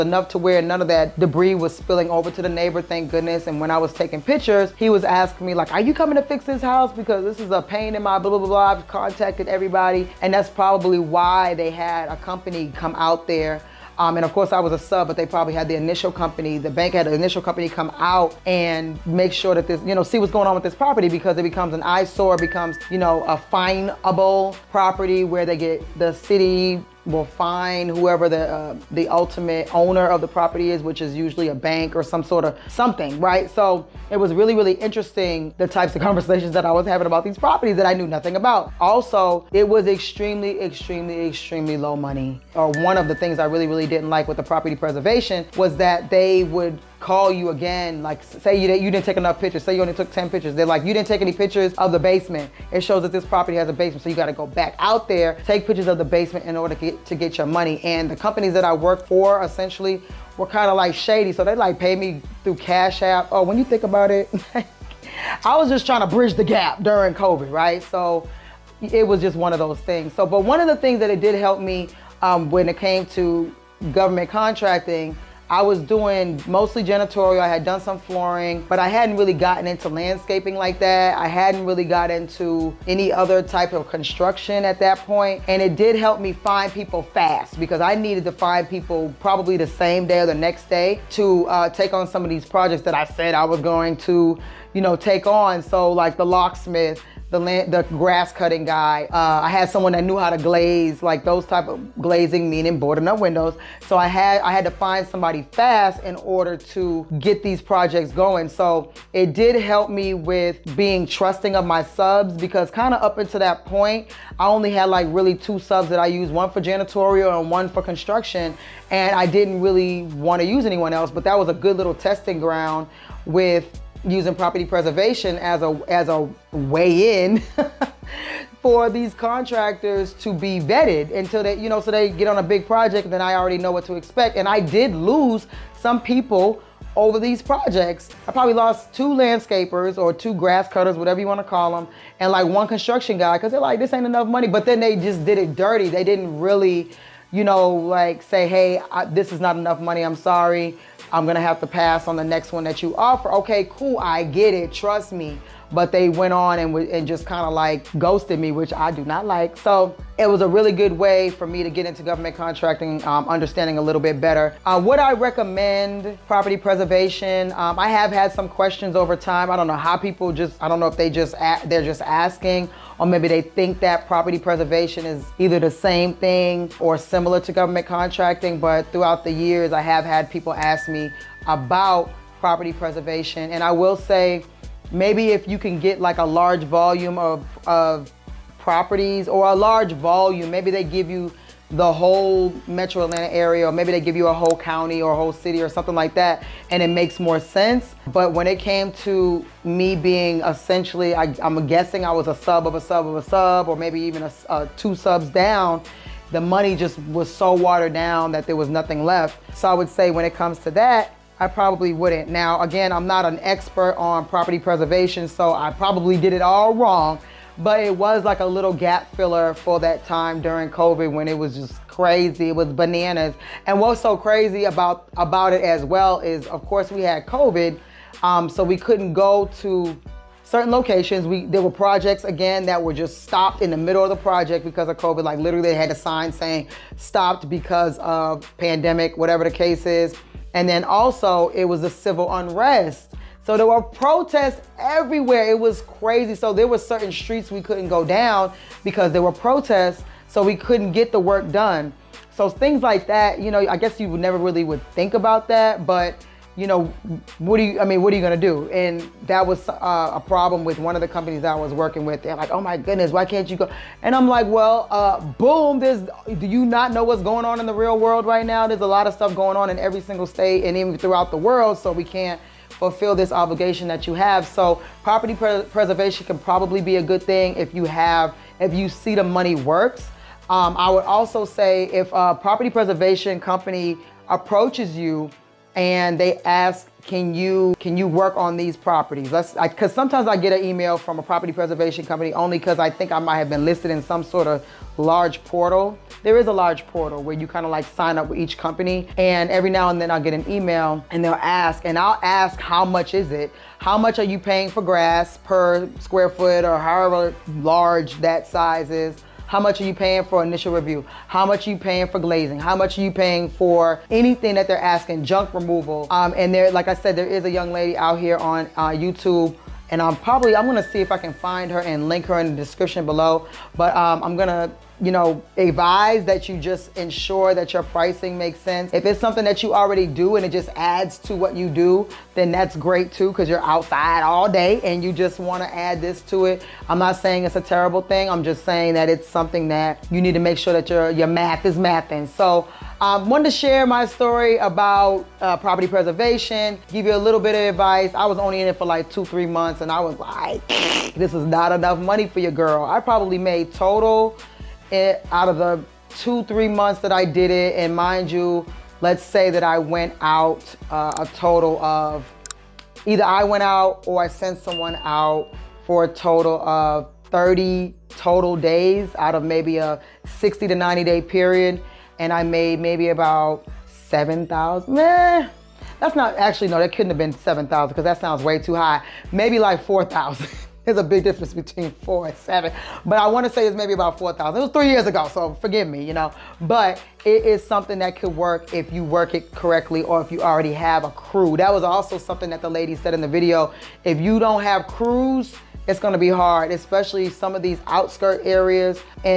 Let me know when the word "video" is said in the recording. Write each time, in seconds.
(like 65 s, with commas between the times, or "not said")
393 s.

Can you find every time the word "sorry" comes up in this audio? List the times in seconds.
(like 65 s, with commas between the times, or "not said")
150 s.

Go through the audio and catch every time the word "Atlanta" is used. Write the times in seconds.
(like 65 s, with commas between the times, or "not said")
193 s.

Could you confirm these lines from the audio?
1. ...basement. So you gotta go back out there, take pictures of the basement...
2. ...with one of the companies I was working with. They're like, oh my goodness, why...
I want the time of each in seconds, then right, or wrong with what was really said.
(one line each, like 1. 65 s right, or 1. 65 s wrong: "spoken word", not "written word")
1. 53 s right
2. 260 s right.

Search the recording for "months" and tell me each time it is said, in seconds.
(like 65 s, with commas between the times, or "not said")
349 s, 356 s.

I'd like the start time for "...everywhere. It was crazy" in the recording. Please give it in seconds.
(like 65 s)
244 s.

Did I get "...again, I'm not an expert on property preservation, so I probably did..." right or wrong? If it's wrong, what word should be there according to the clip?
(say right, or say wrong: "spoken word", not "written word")
right.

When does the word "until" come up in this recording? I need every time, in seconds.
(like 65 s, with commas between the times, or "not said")
113 s, 131 s.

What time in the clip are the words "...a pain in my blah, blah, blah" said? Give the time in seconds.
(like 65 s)
7 s.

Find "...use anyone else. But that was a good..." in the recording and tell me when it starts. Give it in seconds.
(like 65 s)
120 s.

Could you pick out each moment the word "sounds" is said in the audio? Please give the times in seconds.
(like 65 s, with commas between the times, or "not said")
378 s.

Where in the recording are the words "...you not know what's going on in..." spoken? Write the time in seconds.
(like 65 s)
266 s.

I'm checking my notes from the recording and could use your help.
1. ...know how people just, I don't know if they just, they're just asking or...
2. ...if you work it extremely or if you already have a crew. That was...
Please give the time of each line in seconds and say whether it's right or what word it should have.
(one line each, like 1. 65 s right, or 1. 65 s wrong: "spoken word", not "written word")
1. 169 s right
2. 388 s wrong: "correctly", not "extremely".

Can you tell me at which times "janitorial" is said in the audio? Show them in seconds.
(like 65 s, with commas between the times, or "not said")
76 s, 116 s.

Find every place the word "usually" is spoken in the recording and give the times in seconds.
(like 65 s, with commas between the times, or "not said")
31 s.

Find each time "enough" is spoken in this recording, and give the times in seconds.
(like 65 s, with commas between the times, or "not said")
49 s, 144 s, 149 s, 351 s.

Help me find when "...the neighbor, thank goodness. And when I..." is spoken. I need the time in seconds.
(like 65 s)
2 s.